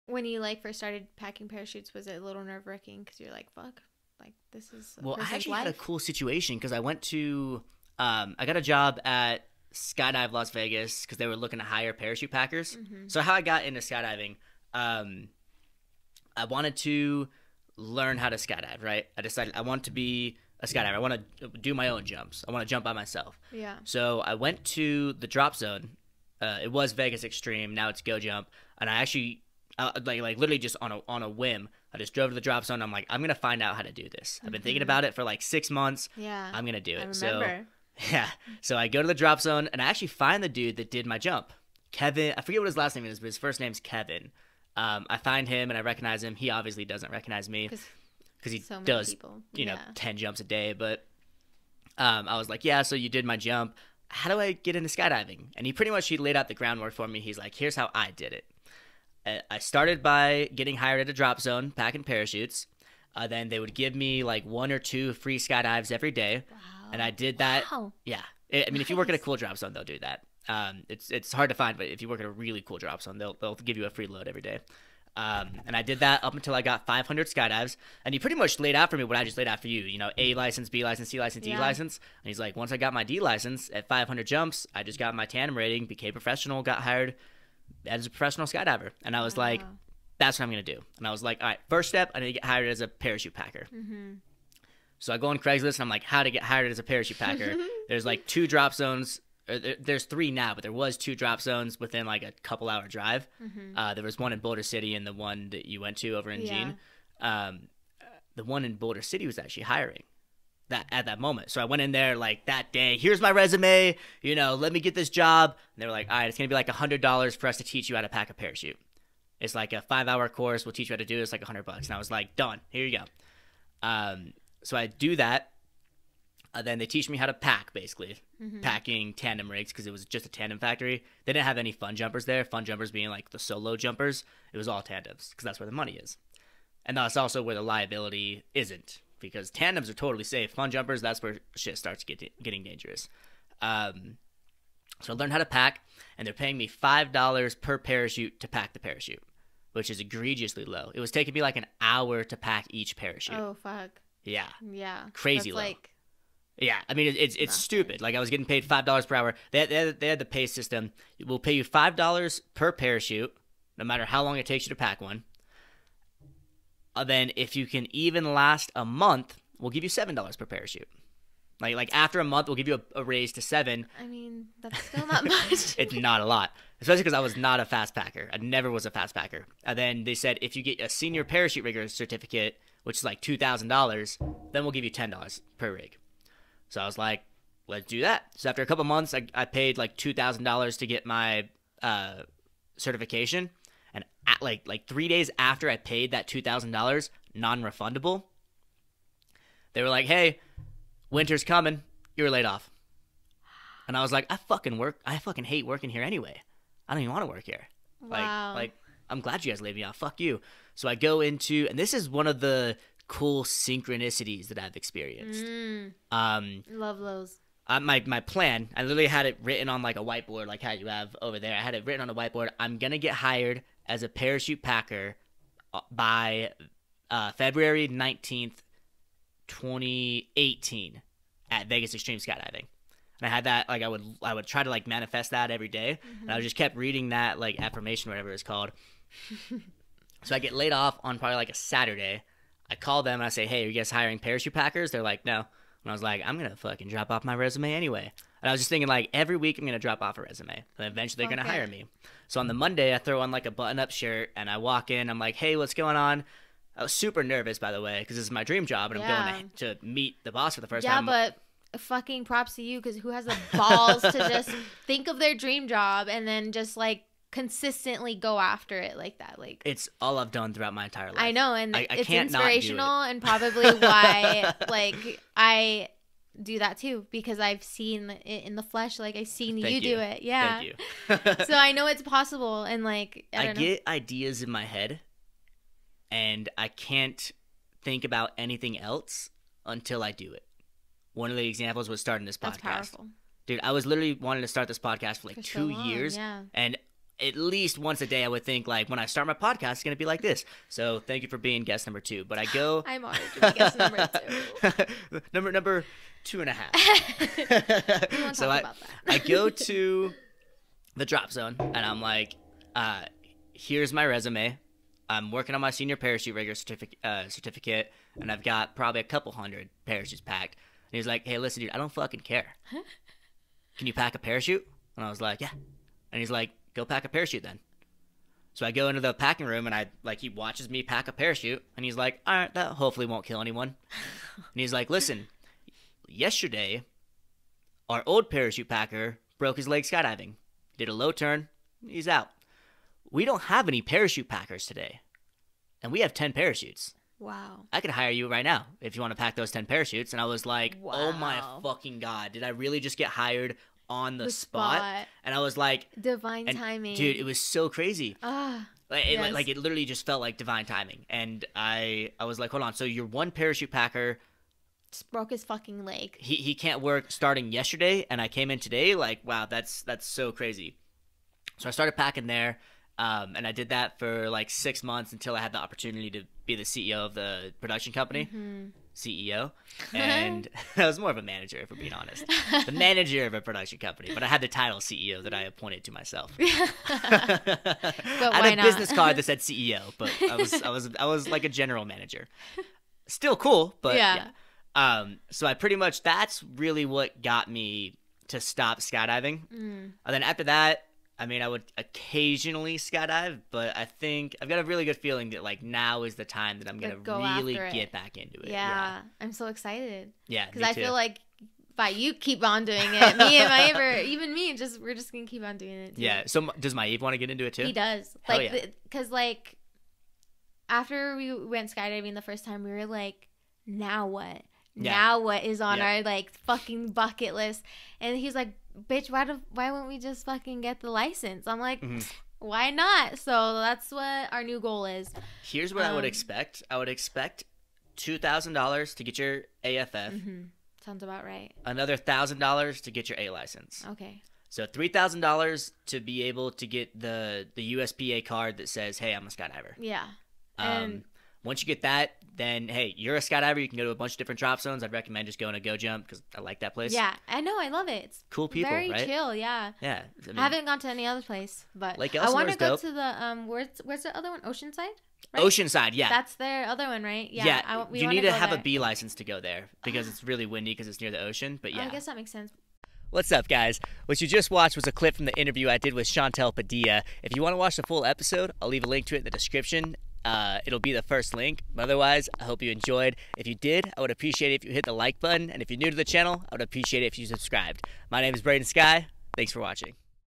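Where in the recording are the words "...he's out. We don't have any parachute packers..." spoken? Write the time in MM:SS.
05:41.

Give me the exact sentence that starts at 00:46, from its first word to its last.
He obviously doesn't recognize me because he so does, people.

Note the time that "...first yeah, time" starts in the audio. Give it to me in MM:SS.
04:20.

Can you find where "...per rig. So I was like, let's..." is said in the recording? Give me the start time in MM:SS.
03:05.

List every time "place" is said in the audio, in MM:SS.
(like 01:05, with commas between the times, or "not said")
07:36, 07:41.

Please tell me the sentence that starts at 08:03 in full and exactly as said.
If you did, I would appreciate it if you hit the like button.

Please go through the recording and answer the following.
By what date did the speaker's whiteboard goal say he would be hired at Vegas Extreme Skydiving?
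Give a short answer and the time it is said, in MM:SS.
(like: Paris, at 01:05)
February 19th, 2018, at 03:47.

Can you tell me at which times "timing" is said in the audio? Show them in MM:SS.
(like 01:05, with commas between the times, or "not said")
05:56, 06:00.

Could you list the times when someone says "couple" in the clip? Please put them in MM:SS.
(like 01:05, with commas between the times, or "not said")
01:42, 03:08, 05:19.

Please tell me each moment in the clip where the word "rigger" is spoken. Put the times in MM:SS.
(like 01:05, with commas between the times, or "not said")
03:01, 05:16.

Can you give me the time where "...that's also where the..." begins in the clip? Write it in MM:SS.
02:16.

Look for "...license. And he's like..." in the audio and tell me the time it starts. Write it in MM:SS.
01:21.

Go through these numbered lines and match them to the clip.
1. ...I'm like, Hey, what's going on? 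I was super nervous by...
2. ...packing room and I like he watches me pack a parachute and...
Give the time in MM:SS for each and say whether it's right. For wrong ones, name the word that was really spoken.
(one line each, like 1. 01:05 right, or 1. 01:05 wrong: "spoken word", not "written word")
1. 04:15 right
2. 05:29 right.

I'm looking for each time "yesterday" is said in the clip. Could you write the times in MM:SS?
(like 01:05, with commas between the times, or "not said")
05:36, 06:07.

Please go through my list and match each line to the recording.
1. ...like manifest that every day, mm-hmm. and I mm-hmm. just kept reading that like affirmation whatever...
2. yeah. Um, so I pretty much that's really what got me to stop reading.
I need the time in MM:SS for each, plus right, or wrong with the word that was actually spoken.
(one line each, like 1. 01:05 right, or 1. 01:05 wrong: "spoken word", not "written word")
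1. 03:54 right
2. 06:34 wrong: "skydiving", not "reading".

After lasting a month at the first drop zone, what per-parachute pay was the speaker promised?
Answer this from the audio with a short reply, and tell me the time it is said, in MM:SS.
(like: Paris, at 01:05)
$7, at 02:49.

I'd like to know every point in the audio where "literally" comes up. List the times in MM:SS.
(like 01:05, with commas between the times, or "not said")
00:30, 03:38, 04:53, 05:59.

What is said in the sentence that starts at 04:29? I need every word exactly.
Like it's all I've done throughout my entire life.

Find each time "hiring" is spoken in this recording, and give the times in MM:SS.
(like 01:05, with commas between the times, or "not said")
01:49, 04:03.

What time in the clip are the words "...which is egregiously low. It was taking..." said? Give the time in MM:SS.
02:29.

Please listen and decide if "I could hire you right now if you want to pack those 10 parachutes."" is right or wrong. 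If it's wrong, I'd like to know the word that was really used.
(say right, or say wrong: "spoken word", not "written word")
right.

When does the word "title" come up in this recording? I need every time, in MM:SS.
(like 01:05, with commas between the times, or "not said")
06:24.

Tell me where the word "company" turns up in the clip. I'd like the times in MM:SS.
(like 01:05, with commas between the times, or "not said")
06:17, 06:23.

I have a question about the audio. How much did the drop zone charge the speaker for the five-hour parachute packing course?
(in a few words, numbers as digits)
$100.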